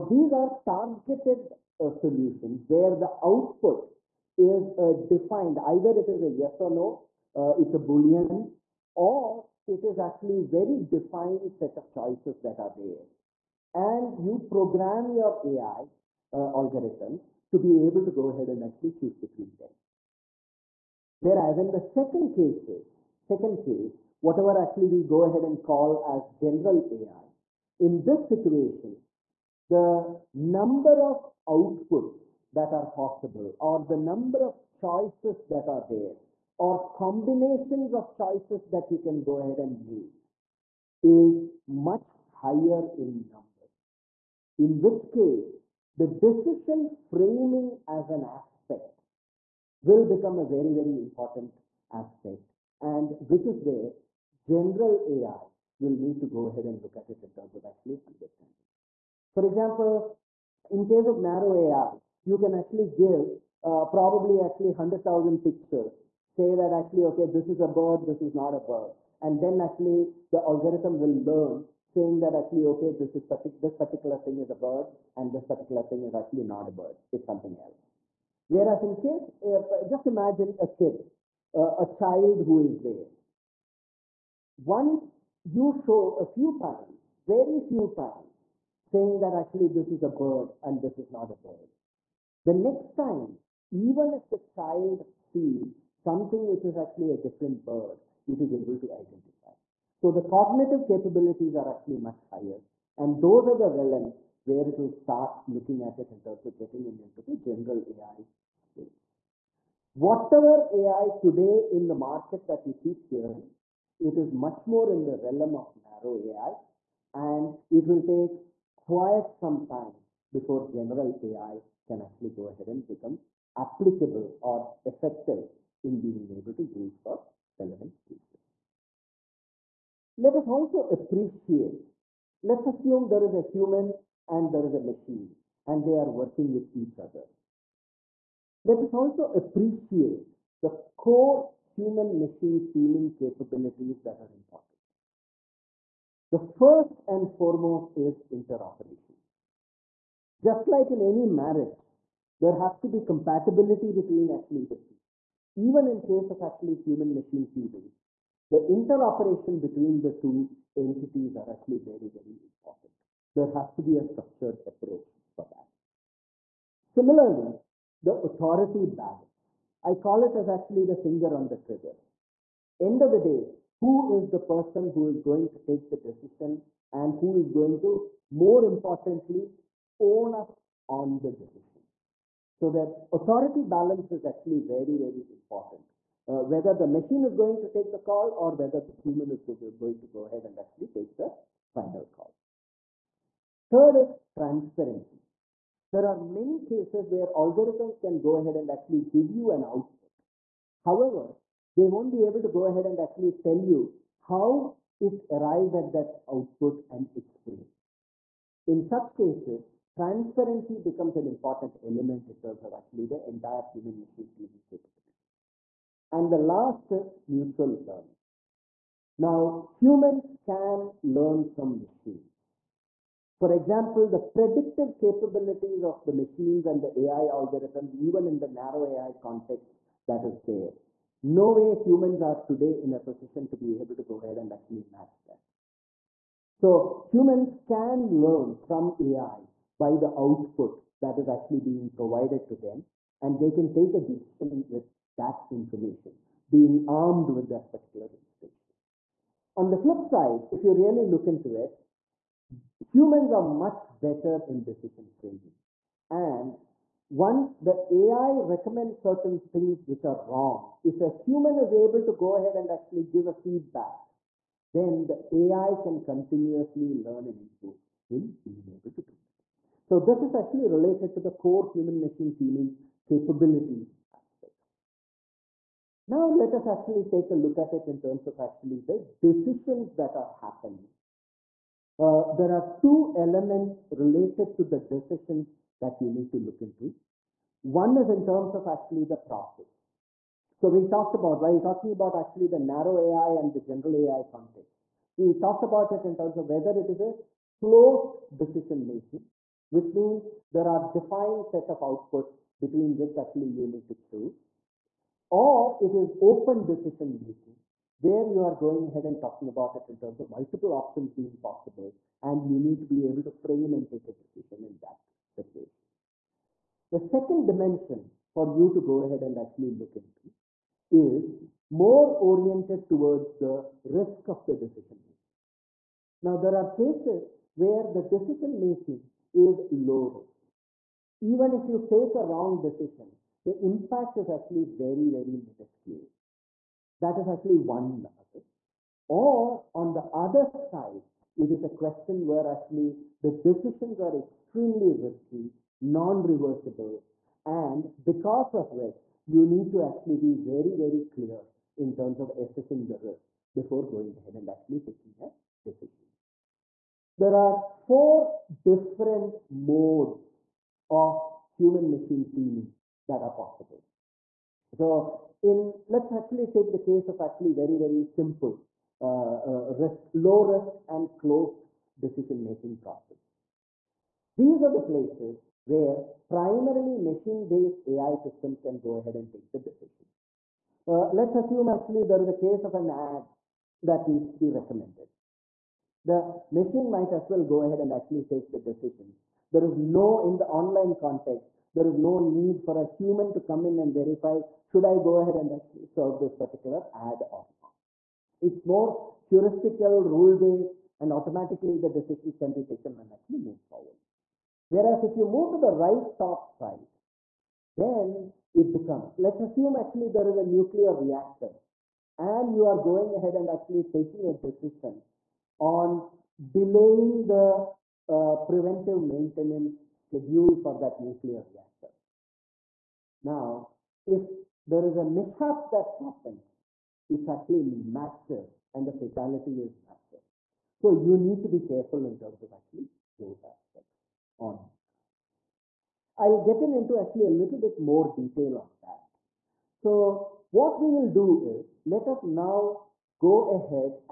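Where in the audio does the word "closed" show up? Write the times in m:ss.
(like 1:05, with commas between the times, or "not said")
4:57, 6:11.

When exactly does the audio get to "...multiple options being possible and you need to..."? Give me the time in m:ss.
5:10.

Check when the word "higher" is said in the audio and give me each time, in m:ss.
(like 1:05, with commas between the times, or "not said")
0:42, 1:42.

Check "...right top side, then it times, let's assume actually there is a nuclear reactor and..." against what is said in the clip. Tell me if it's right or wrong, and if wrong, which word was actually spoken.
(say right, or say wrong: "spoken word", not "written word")
wrong: "becomes", not "times".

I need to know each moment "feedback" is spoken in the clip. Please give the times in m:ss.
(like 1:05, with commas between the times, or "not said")
4:23.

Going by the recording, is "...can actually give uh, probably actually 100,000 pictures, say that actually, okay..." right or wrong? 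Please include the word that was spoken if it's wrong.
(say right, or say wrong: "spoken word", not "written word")
right.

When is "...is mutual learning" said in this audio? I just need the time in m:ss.
3:36.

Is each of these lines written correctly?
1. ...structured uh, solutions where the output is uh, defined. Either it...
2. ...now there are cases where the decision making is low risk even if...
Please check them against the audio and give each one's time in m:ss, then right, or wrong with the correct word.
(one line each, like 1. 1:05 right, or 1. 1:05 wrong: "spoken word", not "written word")
1. 0:00 wrong: "targeted", not "structured"
2. 5:26 right.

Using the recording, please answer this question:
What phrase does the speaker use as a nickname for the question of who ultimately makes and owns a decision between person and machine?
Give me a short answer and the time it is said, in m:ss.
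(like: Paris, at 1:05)
finger on the trigger, at 2:50.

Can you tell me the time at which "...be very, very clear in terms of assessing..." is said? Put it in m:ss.
5:50.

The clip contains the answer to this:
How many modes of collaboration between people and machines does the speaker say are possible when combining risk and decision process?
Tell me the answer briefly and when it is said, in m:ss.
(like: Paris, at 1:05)
4, at 5:57.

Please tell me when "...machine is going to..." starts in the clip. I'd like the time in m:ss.
3:06.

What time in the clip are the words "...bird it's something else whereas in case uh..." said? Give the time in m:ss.
1:16.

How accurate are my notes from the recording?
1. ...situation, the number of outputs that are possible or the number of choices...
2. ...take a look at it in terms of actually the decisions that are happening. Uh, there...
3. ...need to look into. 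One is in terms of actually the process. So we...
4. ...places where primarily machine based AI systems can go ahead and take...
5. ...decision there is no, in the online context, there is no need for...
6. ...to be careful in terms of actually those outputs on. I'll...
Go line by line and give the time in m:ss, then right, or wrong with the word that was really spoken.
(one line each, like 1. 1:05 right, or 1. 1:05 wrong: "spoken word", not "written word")
1. 0:28 right
2. 4:37 right
3. 4:46 right
4. 6:14 right
5. 6:28 right
6. 7:11 wrong: "aspects", not "outputs".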